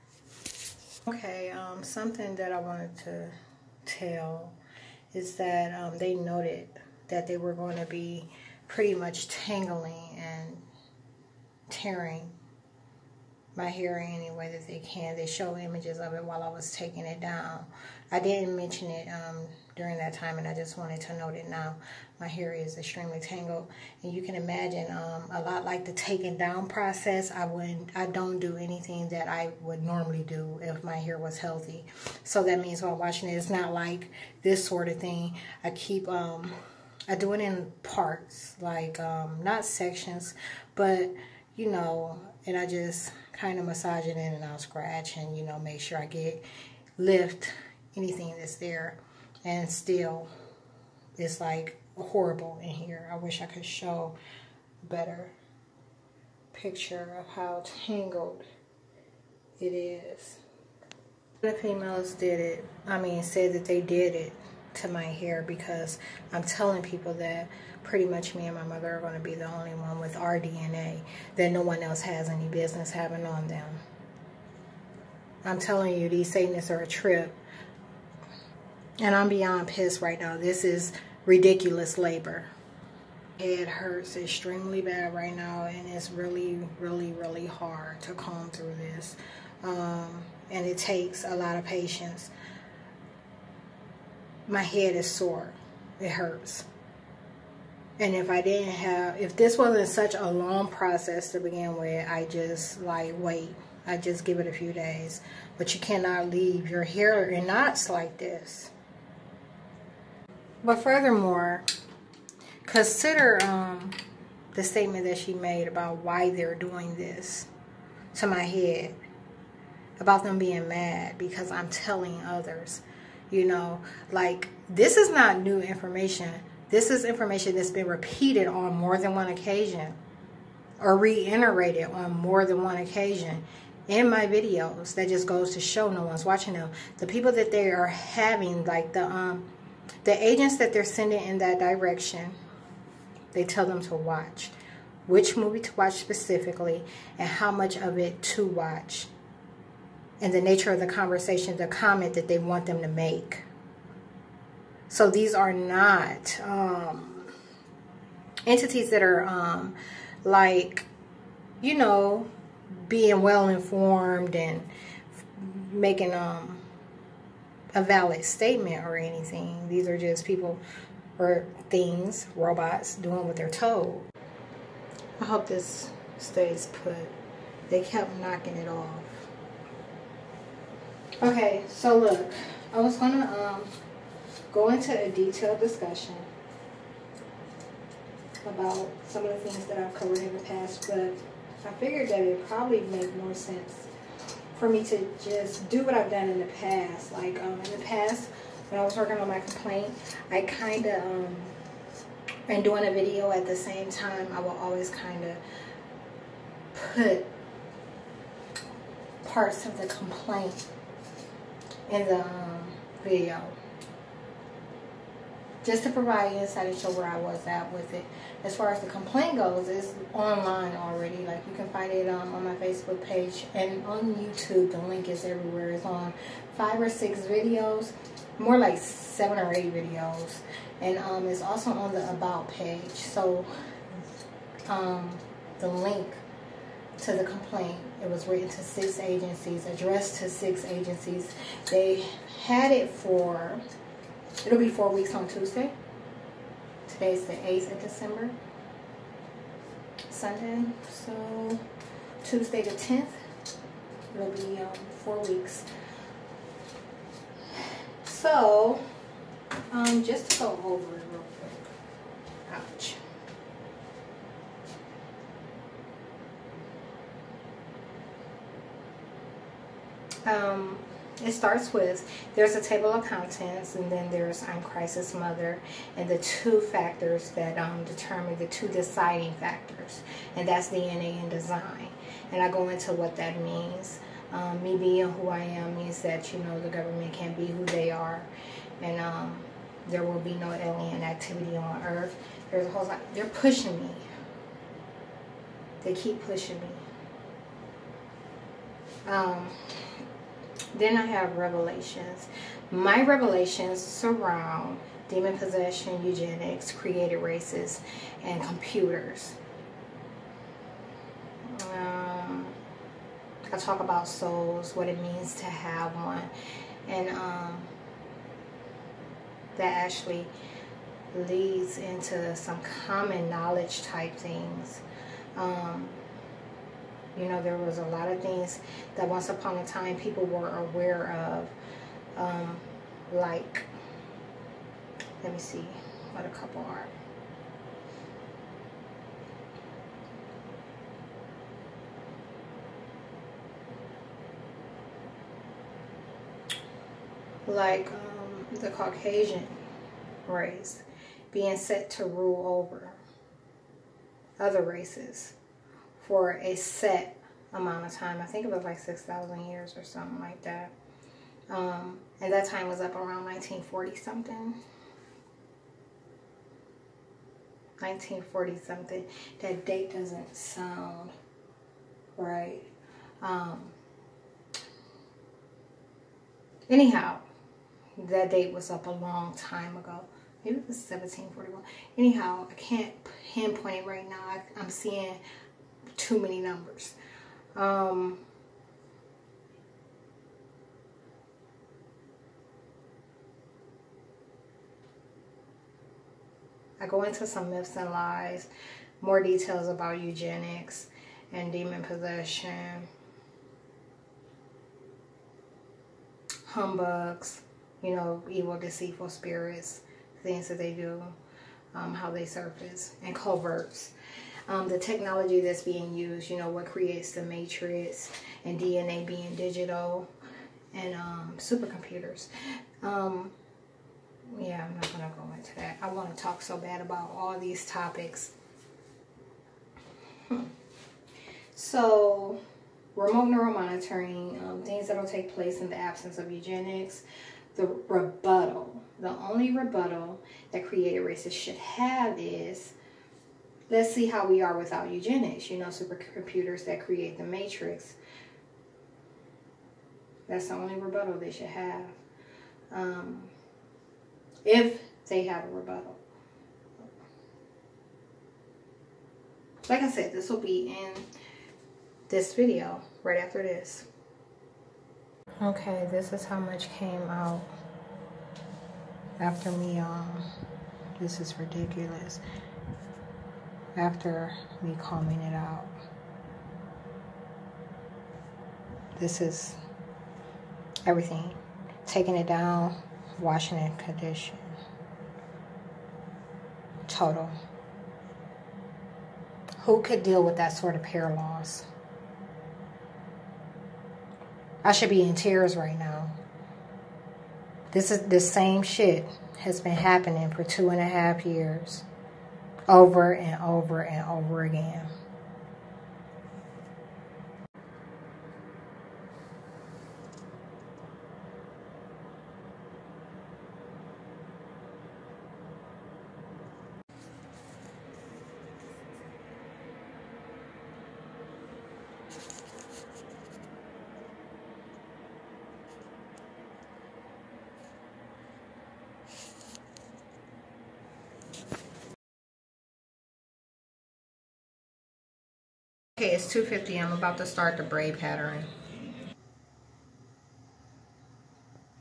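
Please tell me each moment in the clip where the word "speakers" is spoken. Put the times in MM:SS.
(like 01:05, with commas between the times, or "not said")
not said.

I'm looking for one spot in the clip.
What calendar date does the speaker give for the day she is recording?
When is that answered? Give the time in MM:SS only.
04:07.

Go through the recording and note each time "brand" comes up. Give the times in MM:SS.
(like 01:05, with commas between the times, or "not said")
not said.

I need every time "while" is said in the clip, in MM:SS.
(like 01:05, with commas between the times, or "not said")
00:16, 00:32.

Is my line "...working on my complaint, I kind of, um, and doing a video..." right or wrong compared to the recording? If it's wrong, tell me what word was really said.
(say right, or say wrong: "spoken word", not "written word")
right.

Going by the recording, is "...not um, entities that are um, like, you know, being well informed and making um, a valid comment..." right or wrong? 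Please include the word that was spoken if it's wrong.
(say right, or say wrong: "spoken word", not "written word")
wrong: "statement", not "comment".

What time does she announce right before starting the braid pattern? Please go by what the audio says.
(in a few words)
2:50.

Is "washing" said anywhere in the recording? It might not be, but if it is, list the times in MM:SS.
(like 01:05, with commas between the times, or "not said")
00:32, 08:03.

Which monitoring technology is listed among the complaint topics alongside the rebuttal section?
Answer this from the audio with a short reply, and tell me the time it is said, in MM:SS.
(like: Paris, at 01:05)
remote neuromonitoring, at 07:12.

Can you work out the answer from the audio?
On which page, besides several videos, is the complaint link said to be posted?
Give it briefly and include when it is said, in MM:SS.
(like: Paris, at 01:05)
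About page, at 03:52.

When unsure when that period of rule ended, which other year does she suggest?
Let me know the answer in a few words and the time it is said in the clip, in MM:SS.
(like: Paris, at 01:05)
1741, at 06:20.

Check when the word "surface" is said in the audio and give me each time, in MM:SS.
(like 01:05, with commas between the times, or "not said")
06:52.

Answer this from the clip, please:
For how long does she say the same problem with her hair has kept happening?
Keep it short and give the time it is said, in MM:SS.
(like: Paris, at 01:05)
two and a half years, at 08:20.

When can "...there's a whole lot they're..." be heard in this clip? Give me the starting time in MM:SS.
04:52.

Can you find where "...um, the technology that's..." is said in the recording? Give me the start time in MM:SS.
06:54.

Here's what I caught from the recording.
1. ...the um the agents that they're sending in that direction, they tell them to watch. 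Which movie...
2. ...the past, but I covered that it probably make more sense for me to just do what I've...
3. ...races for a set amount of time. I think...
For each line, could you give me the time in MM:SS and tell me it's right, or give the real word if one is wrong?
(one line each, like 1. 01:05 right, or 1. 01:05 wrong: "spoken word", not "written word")
1. 02:18 right
2. 03:10 wrong: "figured", not "covered"
3. 05:54 right.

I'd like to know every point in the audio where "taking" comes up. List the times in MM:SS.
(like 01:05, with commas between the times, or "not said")
00:16, 00:25, 08:01.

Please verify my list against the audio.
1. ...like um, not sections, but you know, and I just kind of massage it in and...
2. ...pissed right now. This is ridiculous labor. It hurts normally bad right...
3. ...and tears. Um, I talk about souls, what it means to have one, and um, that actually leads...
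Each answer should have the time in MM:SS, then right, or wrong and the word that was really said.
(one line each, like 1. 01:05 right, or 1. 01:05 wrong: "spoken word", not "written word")
1. 00:38 right
2. 01:19 wrong: "extremely", not "normally"
3. 05:08 wrong: "computers", not "tears".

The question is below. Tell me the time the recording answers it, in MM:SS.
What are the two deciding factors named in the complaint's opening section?
04:40.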